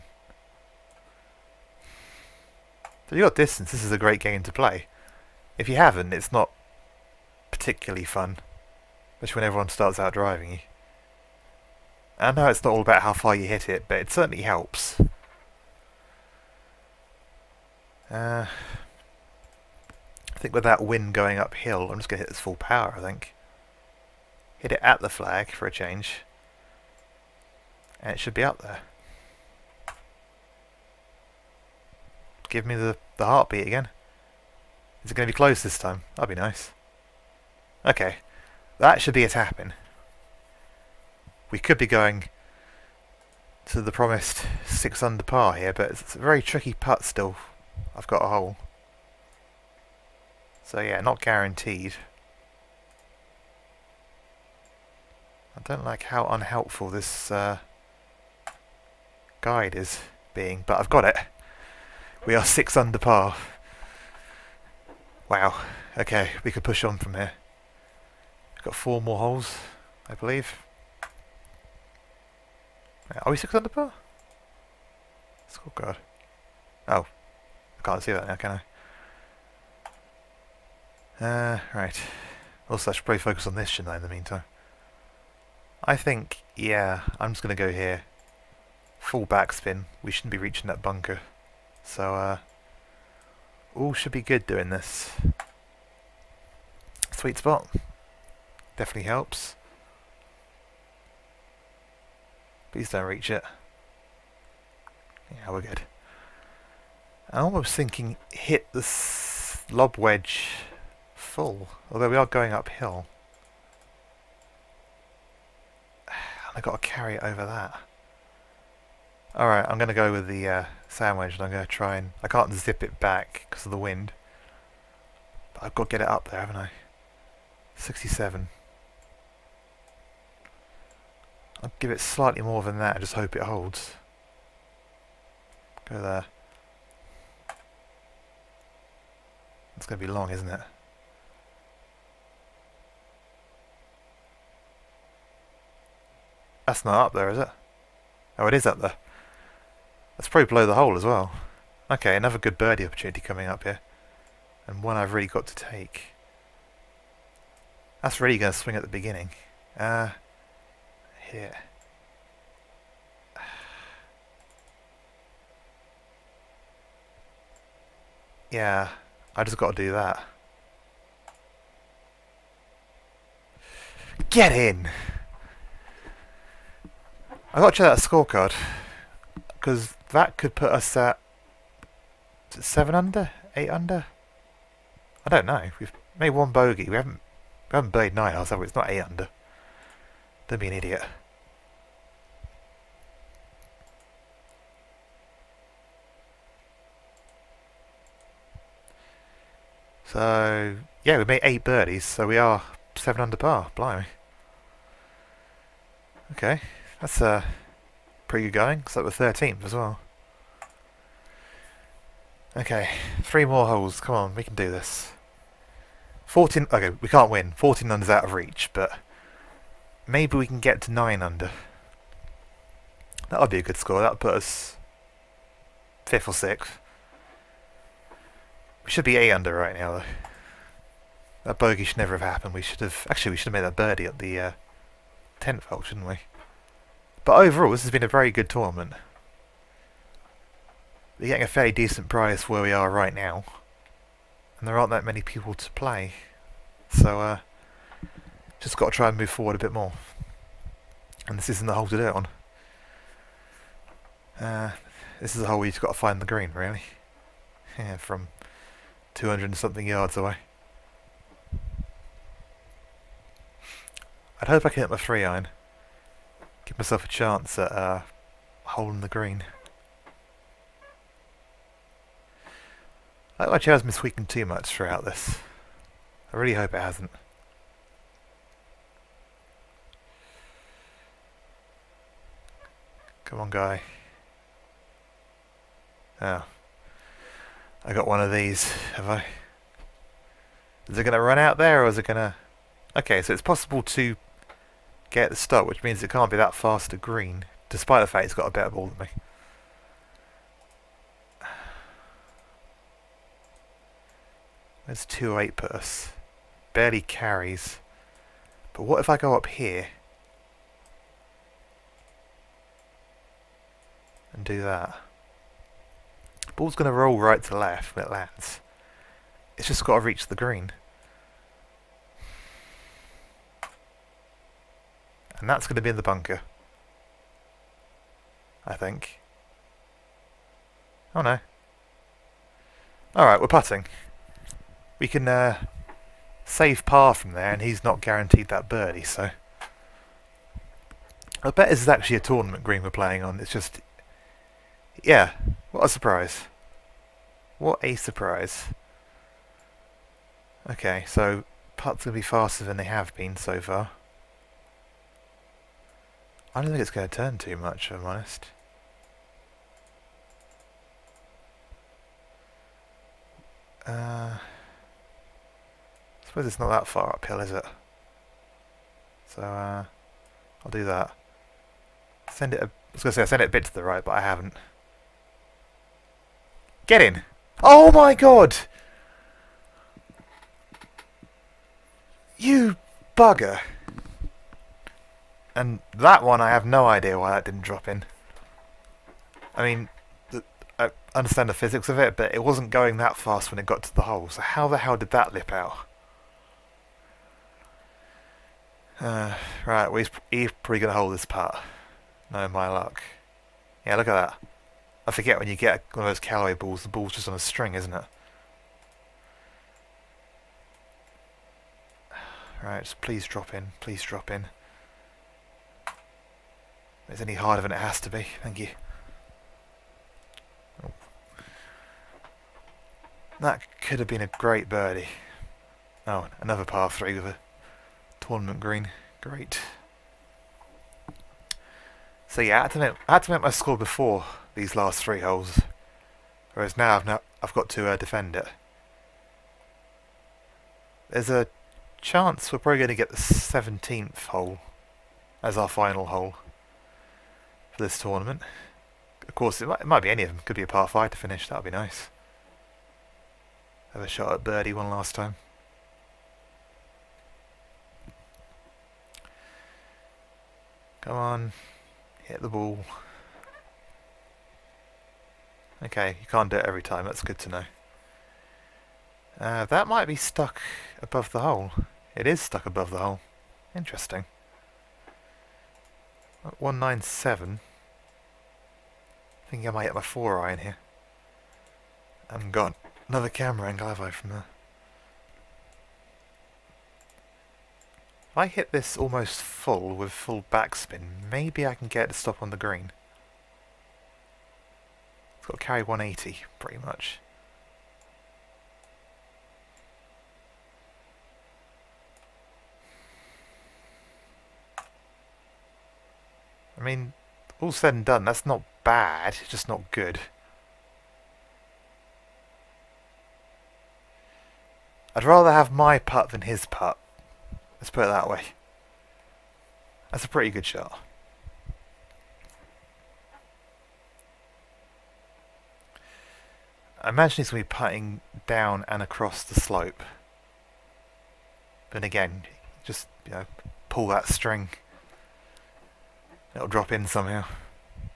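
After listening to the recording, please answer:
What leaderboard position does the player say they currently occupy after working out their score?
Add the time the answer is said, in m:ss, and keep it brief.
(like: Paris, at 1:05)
13th, at 3:29.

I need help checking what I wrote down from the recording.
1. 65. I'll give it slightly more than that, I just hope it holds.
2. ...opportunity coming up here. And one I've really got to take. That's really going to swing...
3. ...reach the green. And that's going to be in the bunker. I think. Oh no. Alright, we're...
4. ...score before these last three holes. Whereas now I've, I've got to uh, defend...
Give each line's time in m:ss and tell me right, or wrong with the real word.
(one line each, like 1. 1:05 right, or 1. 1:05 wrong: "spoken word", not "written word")
1. 2:07 wrong: "67", not "65"
2. 2:32 right
3. 5:20 right
4. 7:13 right.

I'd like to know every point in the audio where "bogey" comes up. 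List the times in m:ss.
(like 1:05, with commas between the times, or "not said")
3:06, 3:51.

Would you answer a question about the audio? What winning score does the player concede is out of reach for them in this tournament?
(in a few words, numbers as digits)
14 under.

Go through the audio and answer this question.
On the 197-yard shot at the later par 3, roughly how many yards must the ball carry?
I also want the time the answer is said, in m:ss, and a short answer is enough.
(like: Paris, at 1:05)
180, at 8:15.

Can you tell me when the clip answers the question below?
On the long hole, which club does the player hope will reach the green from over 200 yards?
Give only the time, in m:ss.
4:24.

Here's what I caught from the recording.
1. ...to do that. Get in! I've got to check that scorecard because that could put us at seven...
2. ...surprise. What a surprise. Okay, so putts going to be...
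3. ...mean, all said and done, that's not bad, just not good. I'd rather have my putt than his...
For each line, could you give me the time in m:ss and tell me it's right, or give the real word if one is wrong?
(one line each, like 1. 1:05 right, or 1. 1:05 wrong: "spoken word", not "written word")
1. 2:49 right
2. 5:45 right
3. 8:26 right.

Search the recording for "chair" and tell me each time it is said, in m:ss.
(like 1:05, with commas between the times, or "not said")
4:33.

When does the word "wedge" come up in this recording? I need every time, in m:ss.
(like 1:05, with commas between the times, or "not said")
1:49, 2:01.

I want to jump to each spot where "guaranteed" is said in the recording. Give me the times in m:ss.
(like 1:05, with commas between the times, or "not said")
0:51, 5:38.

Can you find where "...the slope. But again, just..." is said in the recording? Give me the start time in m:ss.
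8:49.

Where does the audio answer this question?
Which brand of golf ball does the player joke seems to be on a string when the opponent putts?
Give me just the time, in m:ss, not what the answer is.
6:46.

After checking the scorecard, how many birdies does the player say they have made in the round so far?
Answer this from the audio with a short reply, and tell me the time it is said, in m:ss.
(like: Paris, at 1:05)
8, at 3:21.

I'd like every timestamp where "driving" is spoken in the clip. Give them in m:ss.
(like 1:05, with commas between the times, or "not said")
0:10.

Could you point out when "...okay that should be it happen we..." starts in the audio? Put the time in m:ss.
0:37.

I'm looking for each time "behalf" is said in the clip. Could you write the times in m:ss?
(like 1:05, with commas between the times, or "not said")
not said.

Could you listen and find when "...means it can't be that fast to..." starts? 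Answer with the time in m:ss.
4:55.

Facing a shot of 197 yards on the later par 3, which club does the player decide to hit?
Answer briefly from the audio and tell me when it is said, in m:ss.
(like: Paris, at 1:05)
four iron, at 8:00.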